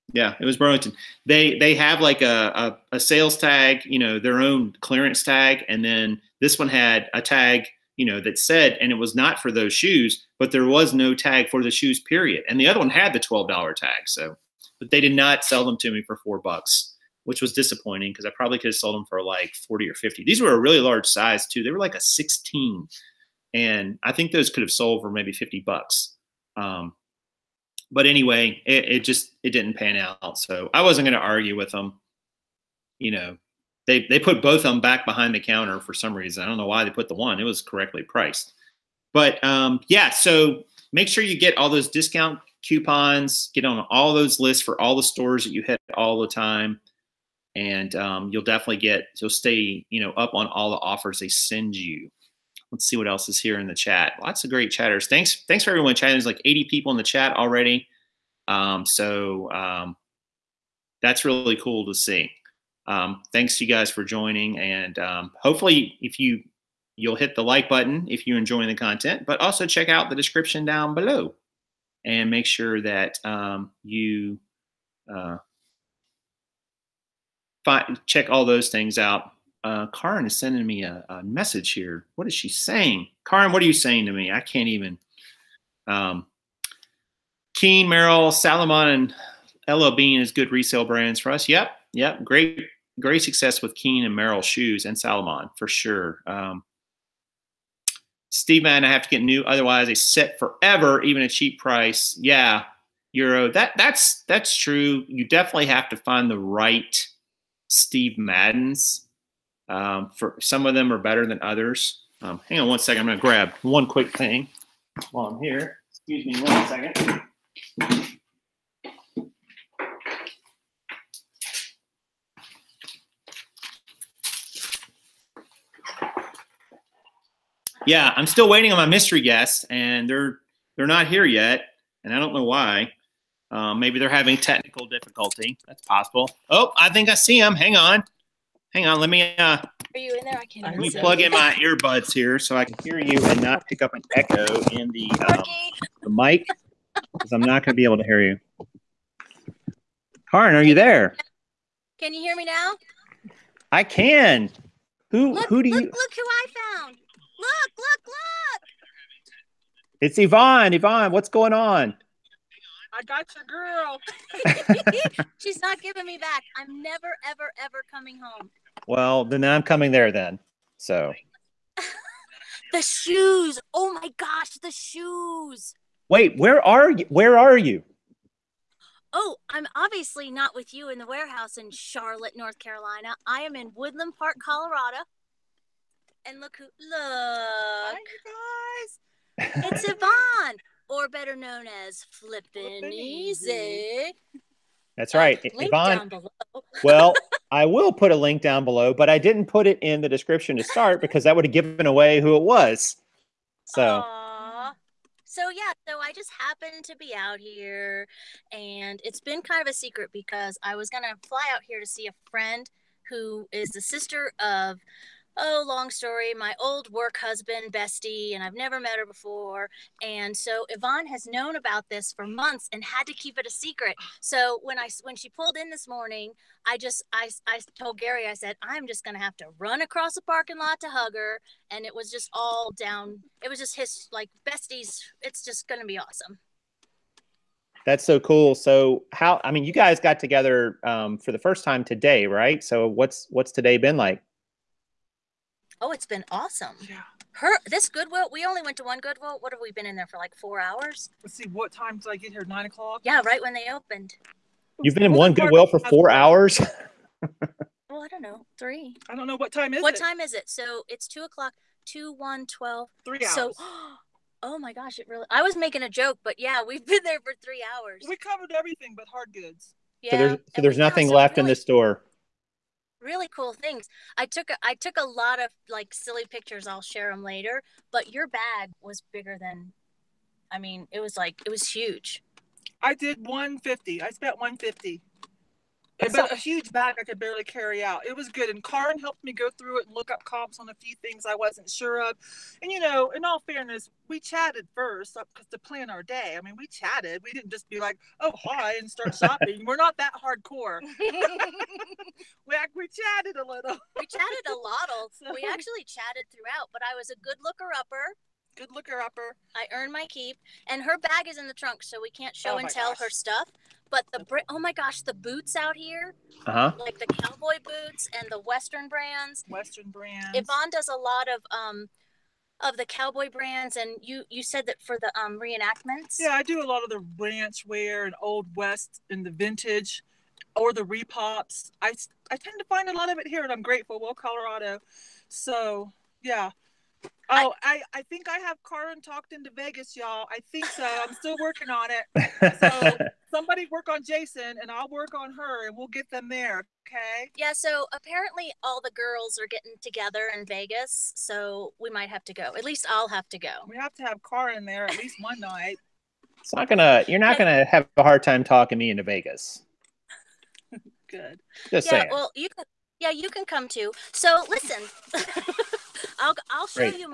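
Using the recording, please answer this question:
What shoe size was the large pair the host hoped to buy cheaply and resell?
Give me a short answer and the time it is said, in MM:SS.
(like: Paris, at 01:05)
16, at 00:22.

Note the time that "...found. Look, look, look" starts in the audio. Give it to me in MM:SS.
02:36.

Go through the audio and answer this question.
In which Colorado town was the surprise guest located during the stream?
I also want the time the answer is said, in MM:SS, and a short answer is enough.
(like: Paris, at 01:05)
Woodland Park, at 03:03.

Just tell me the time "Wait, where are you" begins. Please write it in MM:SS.
02:56.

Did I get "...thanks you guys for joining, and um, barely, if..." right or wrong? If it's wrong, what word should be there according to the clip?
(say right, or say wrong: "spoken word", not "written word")
wrong: "hopefully", not "barely".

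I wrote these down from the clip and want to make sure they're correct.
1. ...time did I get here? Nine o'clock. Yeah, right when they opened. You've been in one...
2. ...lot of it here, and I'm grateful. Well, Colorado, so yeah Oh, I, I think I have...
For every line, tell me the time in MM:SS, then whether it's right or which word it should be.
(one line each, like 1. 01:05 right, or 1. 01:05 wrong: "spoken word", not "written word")
1. 04:11 right
2. 05:32 right.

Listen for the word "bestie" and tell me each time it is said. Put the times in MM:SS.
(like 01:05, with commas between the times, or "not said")
03:37, 03:54.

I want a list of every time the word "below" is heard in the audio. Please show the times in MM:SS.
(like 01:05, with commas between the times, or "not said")
01:10, 03:18.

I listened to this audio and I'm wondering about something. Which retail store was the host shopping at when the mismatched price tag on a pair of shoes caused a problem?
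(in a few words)
Burlington.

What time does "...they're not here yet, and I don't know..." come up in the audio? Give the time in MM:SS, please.
02:10.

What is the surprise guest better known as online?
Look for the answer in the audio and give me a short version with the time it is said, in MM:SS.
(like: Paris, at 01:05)
Flippin' Easy, at 03:12.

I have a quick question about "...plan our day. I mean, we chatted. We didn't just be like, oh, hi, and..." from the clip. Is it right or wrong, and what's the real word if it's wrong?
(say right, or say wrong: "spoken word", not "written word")
right.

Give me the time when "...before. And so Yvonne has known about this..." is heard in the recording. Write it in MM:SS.
03:39.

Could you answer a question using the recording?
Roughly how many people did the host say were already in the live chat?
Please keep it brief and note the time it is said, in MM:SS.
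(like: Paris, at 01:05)
80, at 00:56.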